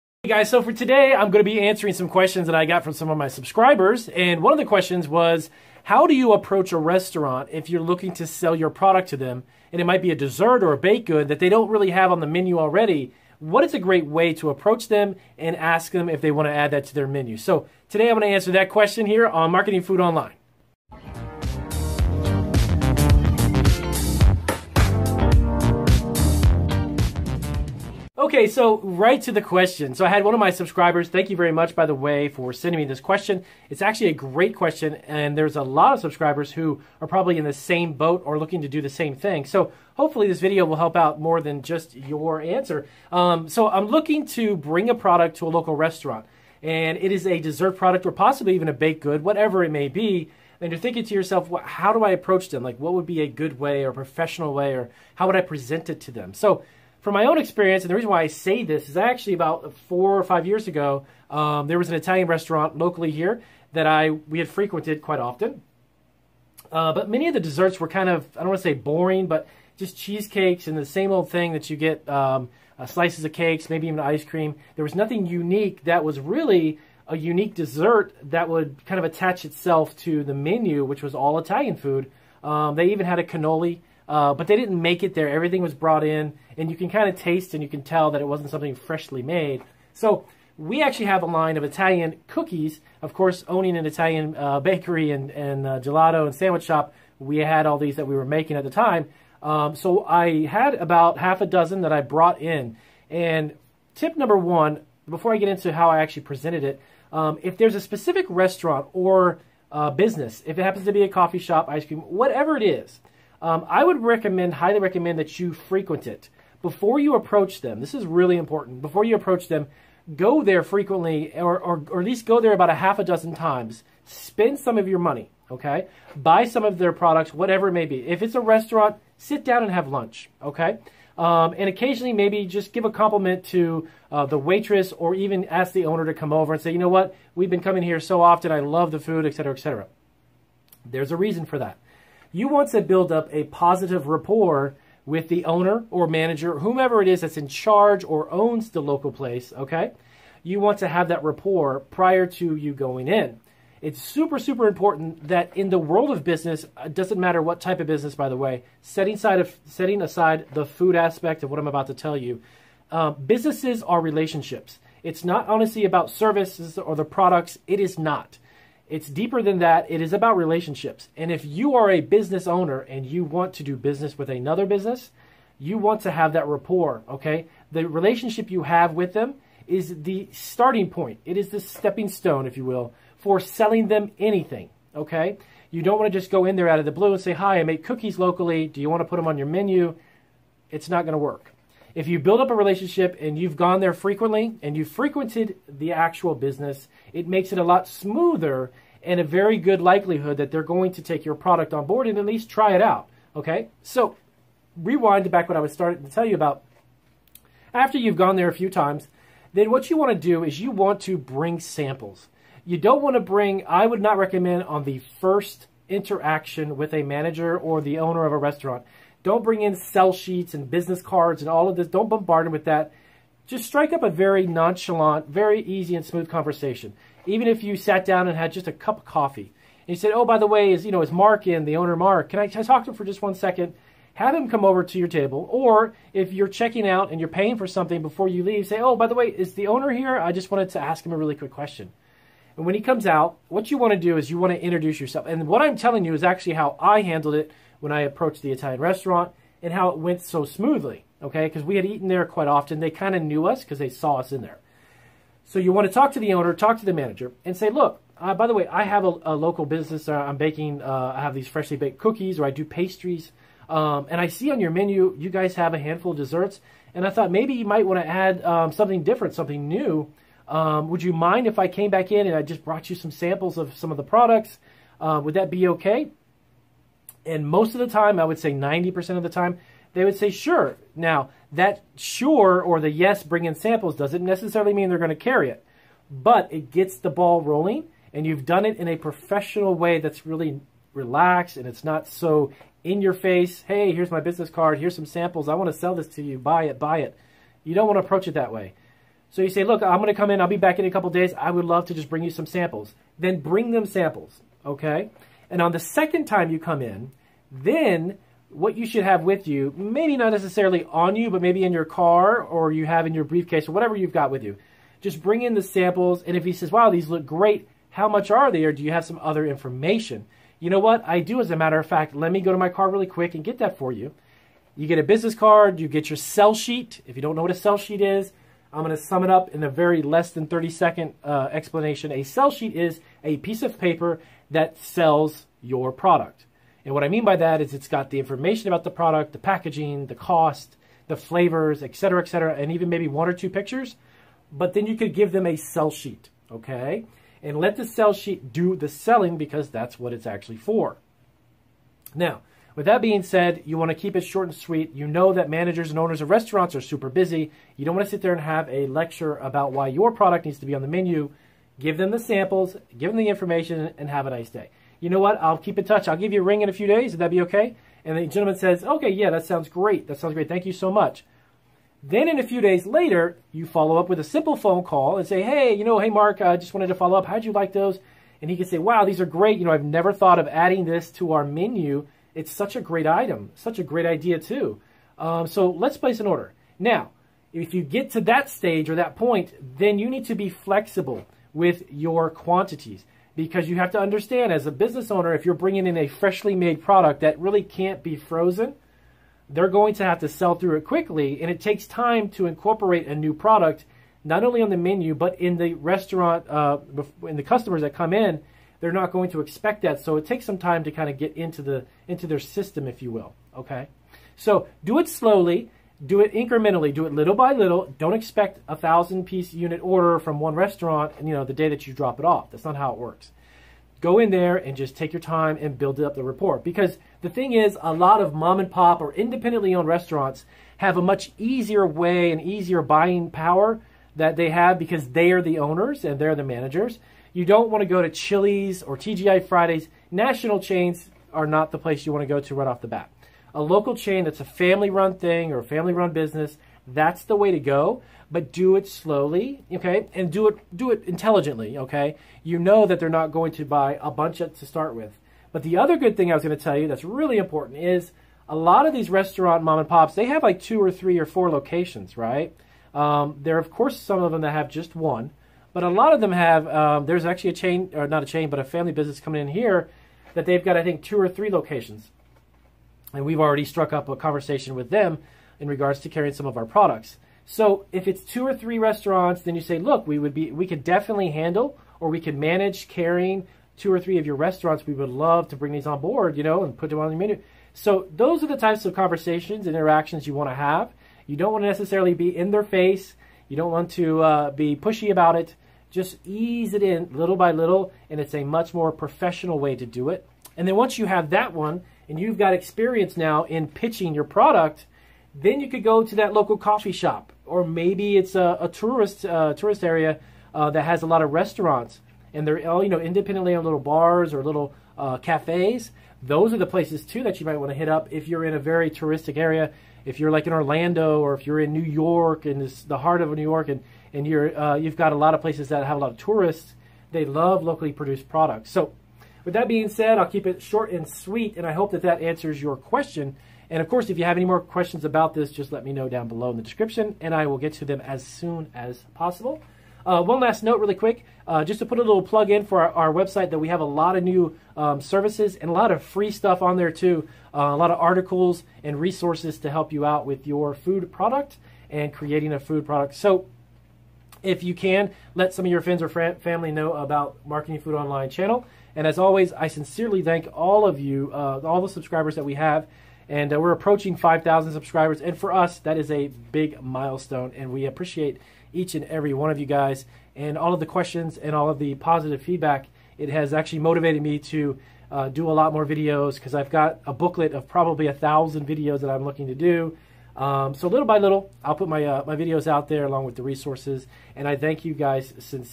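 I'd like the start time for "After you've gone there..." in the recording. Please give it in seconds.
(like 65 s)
207 s.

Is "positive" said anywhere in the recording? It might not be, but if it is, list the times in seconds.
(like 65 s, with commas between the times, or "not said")
143 s, 571 s.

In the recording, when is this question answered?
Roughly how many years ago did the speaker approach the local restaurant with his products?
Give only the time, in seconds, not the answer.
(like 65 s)
59 s.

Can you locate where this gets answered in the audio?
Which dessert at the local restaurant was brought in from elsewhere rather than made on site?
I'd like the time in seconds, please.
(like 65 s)
82 s.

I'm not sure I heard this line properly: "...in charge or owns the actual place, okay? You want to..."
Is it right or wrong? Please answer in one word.
wrong.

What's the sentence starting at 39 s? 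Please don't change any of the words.
So hopefully this video will help out more than just your answer.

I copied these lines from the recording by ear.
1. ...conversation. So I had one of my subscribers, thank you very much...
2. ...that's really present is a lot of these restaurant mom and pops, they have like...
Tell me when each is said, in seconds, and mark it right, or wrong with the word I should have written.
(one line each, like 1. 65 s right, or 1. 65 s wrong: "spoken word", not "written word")
1. 29 s wrong: "question", not "conversation"
2. 456 s wrong: "important", not "present".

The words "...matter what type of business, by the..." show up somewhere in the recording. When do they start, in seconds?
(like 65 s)
157 s.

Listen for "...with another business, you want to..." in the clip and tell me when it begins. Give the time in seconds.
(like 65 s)
174 s.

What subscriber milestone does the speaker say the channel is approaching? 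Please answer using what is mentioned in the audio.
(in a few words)
5,000.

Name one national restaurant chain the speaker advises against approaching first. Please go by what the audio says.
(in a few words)
Chili's.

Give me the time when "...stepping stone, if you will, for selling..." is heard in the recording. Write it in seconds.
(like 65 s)
181 s.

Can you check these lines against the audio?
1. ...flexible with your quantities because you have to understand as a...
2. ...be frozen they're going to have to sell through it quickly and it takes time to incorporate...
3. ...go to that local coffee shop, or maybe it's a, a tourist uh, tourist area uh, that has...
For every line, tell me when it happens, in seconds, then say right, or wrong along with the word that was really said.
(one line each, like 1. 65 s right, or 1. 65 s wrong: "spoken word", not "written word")
1. 390 s right
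2. 398 s right
3. 505 s right.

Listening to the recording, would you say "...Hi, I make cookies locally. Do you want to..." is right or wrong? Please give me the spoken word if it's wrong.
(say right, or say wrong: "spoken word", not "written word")
right.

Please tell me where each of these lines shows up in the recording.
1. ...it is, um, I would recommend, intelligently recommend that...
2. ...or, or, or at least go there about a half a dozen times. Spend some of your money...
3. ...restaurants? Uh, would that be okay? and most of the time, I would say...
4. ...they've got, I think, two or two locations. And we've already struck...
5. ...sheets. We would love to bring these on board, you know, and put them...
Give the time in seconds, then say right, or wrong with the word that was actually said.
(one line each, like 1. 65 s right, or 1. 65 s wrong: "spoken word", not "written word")
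1. 112 s wrong: "highly", not "intelligently"
2. 121 s right
3. 274 s wrong: "products", not "restaurants"
4. 470 s wrong: "three", not "two"
5. 484 s wrong: "restaurants", not "sheets".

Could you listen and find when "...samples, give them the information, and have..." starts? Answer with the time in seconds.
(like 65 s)
362 s.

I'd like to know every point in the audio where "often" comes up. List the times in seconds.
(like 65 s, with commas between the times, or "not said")
65 s, 138 s, 252 s.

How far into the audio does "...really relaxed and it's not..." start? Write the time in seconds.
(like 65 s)
290 s.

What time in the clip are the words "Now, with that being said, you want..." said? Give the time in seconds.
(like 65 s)
352 s.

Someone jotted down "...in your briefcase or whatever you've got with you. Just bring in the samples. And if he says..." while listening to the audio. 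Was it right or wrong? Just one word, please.
right.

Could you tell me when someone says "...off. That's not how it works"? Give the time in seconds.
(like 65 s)
422 s.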